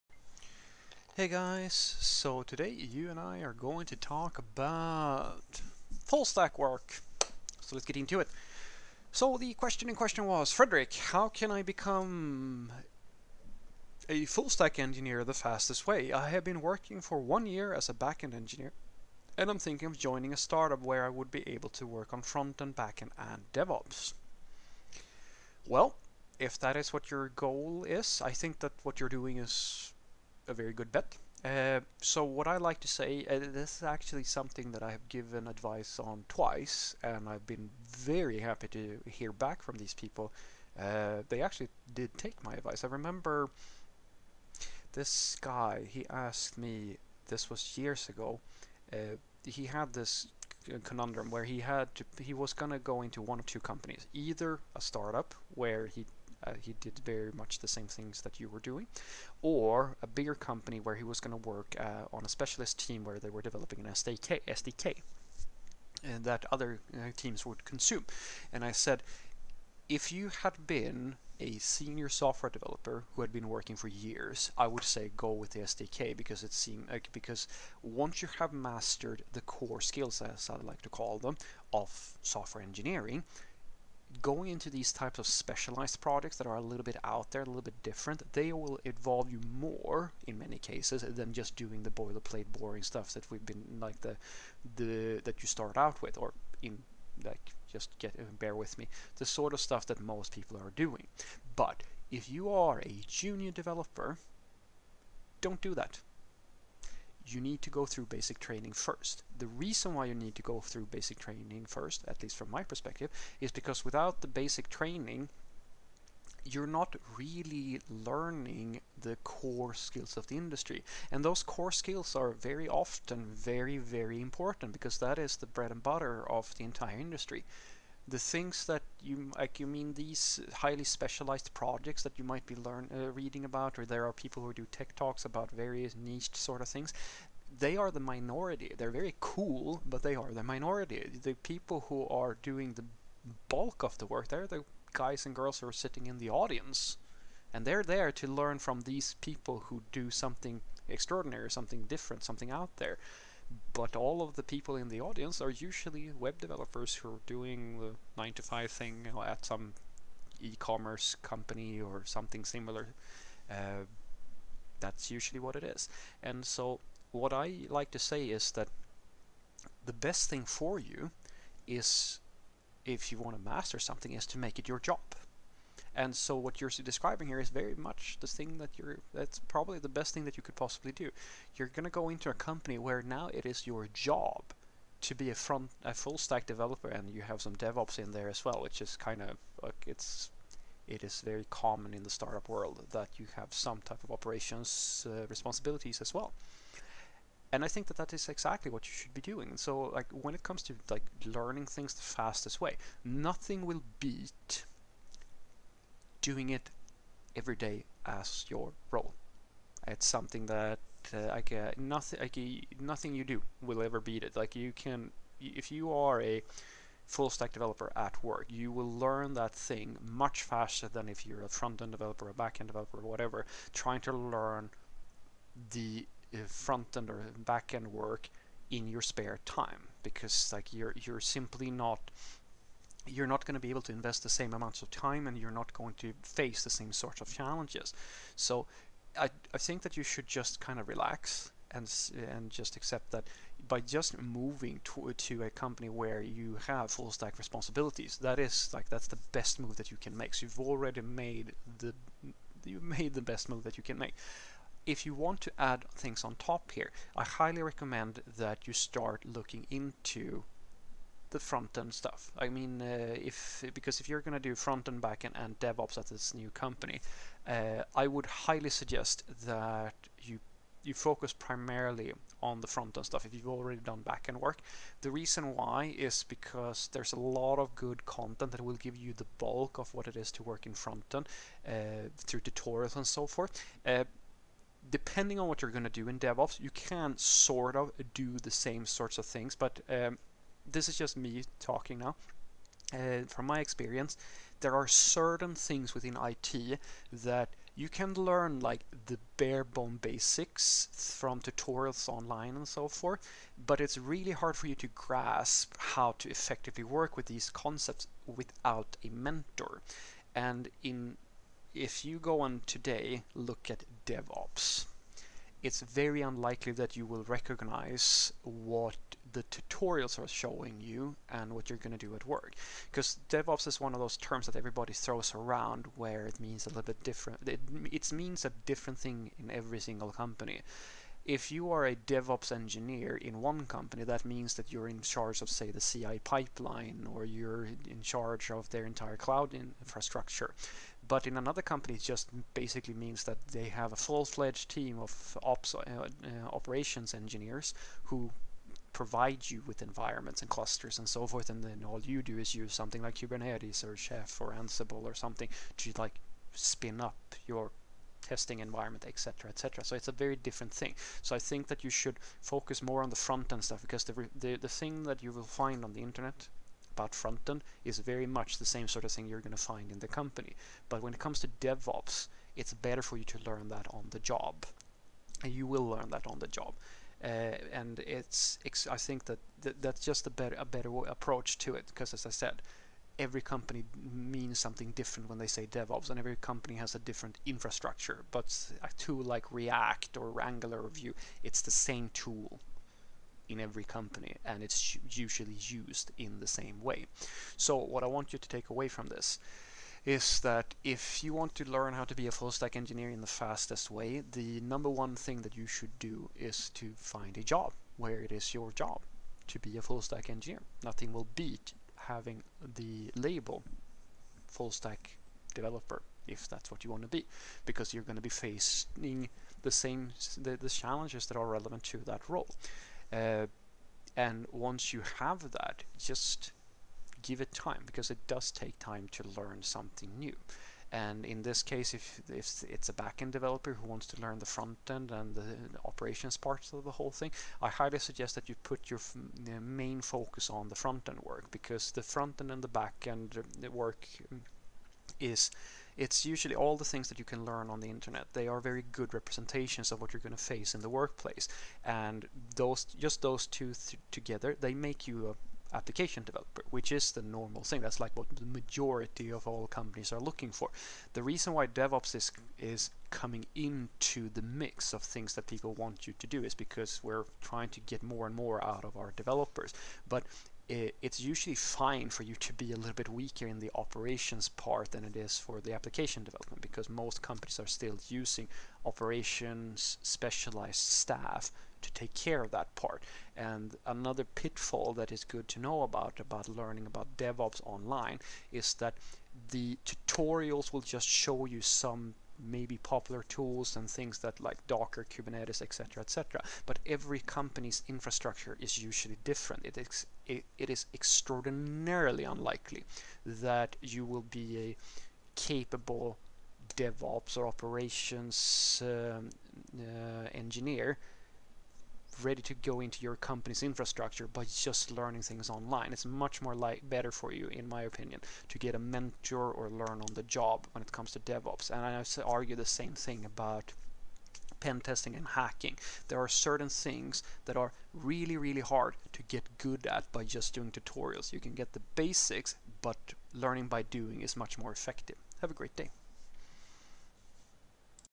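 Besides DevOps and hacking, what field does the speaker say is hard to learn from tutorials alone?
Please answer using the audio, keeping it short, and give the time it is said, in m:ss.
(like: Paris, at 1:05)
pen testing, at 8:44.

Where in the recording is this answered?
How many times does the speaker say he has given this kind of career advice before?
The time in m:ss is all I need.
0:36.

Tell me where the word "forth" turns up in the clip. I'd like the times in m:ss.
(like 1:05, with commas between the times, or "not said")
4:43, 5:02, 5:51.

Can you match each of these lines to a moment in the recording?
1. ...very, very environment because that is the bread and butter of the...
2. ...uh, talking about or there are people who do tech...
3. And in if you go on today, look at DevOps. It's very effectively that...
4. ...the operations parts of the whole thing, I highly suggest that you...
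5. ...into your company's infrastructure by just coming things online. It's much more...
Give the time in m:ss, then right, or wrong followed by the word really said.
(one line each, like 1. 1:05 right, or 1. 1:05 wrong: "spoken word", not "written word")
1. 2:03 wrong: "important", not "environment"
2. 2:12 wrong: "reading", not "talking"
3. 5:10 wrong: "unlikely", not "effectively"
4. 7:15 right
5. 8:32 wrong: "learning", not "coming".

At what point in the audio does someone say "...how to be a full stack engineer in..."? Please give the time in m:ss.
6:41.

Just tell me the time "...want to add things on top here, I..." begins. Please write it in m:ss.
4:15.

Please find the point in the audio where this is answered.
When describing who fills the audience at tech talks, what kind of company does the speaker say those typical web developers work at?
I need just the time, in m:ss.
2:40.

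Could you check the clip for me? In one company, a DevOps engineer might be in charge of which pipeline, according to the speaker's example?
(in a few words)
CI pipeline.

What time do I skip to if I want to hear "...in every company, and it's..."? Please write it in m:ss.
6:33.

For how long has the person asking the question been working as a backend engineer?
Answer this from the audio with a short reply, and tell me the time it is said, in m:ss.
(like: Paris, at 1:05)
one year, at 0:17.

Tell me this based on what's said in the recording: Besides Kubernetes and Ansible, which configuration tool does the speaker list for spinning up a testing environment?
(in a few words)
Chef.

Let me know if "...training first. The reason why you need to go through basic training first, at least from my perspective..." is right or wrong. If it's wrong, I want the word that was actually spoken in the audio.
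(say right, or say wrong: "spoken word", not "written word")
right.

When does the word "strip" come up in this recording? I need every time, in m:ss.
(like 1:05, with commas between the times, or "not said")
not said.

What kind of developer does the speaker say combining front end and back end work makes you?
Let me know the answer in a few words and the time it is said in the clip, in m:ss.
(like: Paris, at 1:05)
application developer, at 7:35.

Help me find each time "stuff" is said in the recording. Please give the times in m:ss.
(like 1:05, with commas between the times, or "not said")
1:32, 1:39, 4:21, 4:33, 6:03.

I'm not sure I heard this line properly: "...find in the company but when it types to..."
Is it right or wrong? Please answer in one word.
wrong.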